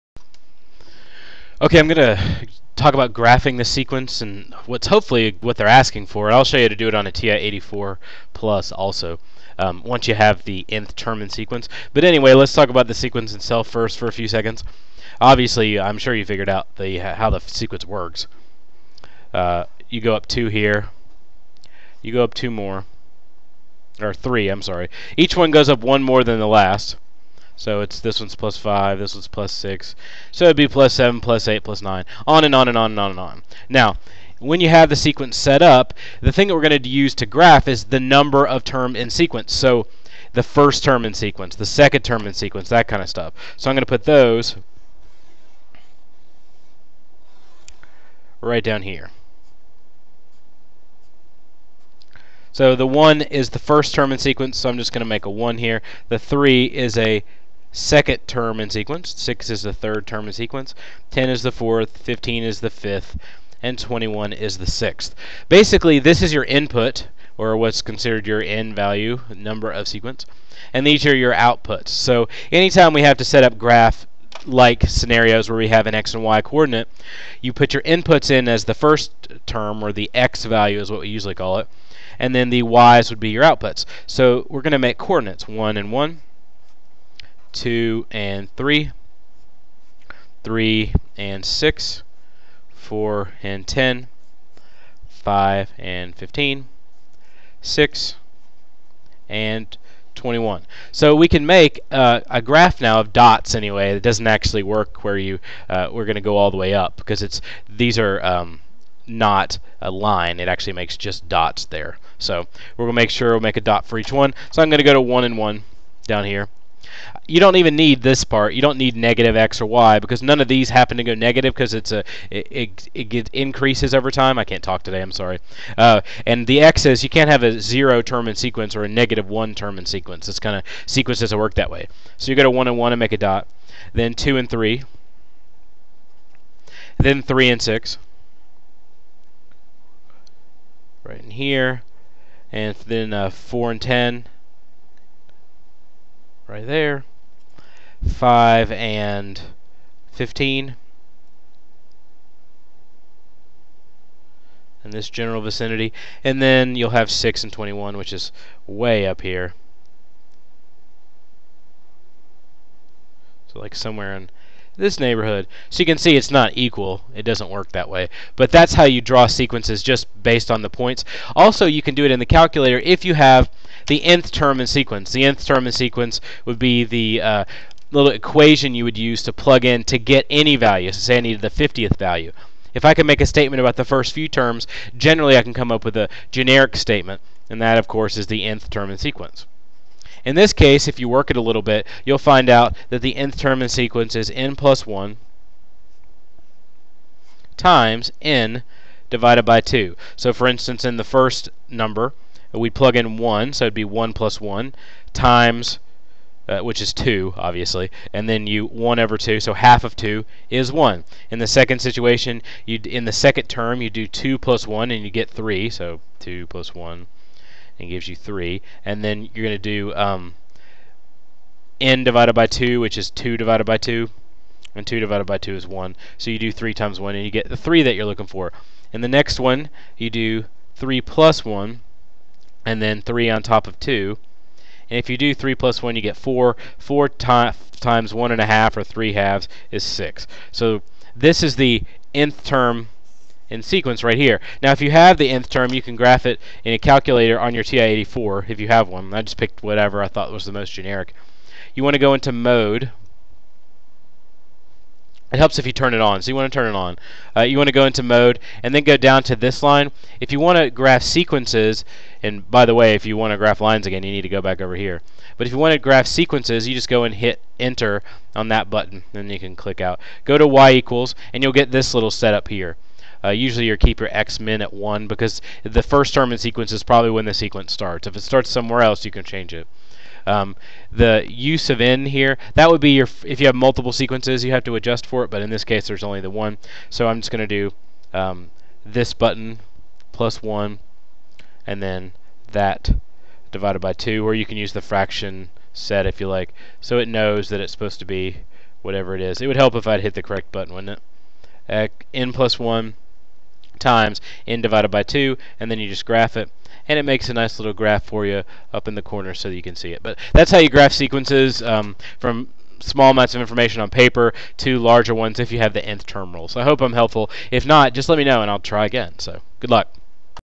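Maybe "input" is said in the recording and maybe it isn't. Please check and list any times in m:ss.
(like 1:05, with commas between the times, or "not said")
1:06, 1:17.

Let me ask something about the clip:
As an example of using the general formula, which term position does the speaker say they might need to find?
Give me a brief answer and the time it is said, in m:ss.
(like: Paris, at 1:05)
50th, at 3:01.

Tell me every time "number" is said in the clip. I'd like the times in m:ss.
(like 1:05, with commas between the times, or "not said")
0:37, 1:09, 3:21.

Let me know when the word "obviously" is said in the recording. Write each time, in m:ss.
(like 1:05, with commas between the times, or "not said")
0:15, 3:27.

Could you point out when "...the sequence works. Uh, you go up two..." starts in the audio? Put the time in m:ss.
0:17.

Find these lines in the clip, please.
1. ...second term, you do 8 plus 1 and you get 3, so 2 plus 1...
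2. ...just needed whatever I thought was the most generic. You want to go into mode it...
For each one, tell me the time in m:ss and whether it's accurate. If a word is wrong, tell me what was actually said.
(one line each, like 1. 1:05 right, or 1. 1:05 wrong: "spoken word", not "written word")
1. 3:33 wrong: "2", not "8"
2. 4:09 wrong: "picked", not "needed".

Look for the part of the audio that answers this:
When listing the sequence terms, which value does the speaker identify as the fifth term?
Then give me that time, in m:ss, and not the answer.
1:01.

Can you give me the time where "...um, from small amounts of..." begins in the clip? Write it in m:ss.
5:11.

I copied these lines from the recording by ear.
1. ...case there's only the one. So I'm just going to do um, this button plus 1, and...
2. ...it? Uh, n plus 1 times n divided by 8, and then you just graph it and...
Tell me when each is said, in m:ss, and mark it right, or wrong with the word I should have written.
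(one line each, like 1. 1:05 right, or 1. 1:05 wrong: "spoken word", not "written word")
1. 4:45 right
2. 5:00 wrong: "2", not "8".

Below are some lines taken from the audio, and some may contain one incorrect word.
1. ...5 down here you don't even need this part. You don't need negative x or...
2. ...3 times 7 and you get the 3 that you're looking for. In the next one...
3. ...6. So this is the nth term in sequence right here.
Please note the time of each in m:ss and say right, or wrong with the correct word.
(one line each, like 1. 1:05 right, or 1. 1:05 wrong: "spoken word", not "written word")
1. 1:55 wrong: "1", not "5"
2. 3:46 wrong: "1", not "7"
3. 3:59 right.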